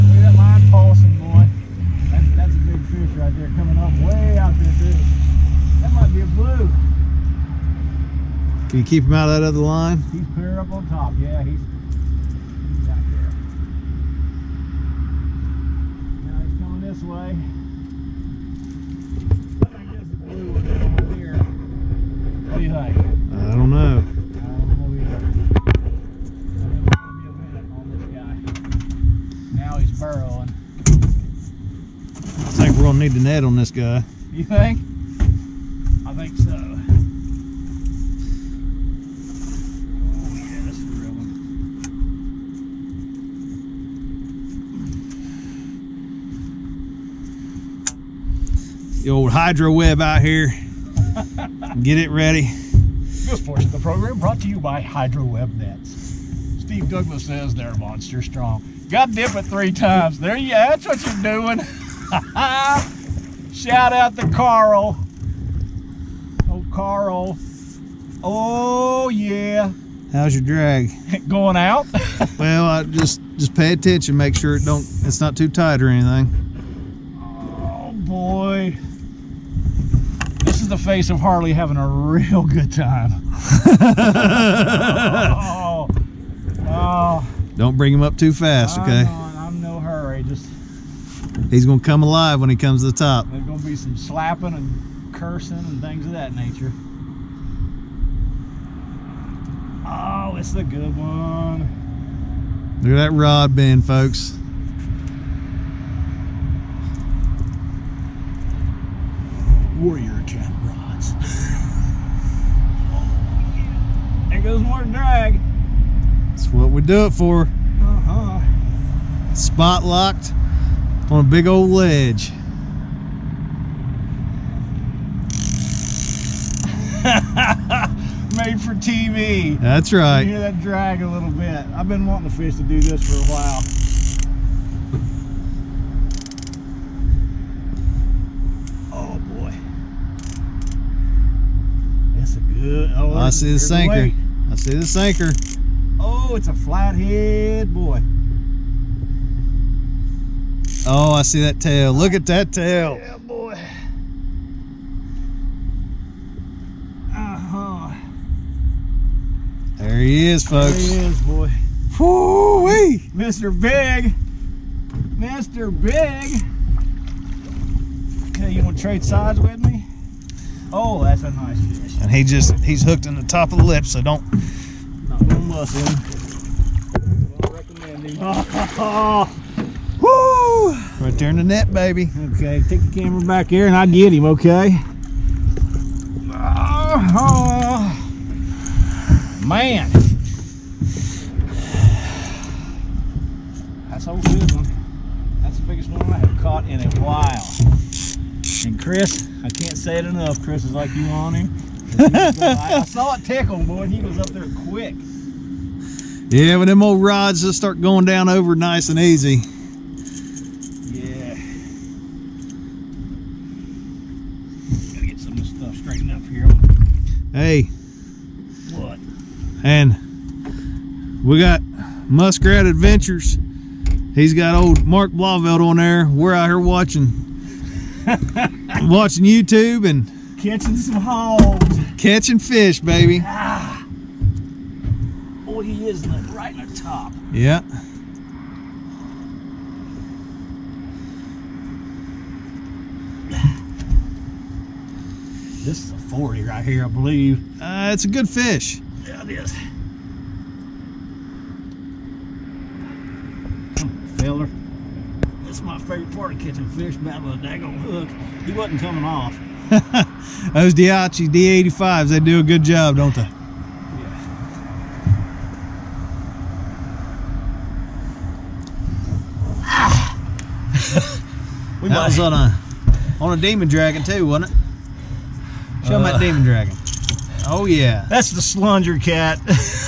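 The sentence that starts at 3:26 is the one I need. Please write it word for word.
Yeah, when them old rods just start going down over nice and easy.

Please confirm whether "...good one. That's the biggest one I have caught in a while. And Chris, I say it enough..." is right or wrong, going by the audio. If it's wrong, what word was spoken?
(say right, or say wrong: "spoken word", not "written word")
right.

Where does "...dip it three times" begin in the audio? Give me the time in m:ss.
0:59.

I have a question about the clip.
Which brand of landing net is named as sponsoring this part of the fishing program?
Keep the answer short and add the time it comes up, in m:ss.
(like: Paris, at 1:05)
Hydro Web Nets, at 0:54.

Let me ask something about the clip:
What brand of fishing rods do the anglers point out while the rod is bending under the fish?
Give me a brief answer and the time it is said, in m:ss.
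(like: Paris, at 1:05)
Warrior Cat, at 1:49.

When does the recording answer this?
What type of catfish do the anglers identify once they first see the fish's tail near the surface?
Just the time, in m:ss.
2:26.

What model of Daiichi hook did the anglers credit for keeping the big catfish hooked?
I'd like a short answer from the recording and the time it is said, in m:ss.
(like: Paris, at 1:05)
D85, at 4:20.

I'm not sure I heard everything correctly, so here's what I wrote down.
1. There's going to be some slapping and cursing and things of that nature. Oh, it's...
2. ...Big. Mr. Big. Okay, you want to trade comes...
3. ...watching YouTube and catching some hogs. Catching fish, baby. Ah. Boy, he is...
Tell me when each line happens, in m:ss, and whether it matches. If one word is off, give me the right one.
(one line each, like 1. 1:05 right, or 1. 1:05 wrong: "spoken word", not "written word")
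1. 1:33 right
2. 2:43 wrong: "sides", not "comes"
3. 3:48 right.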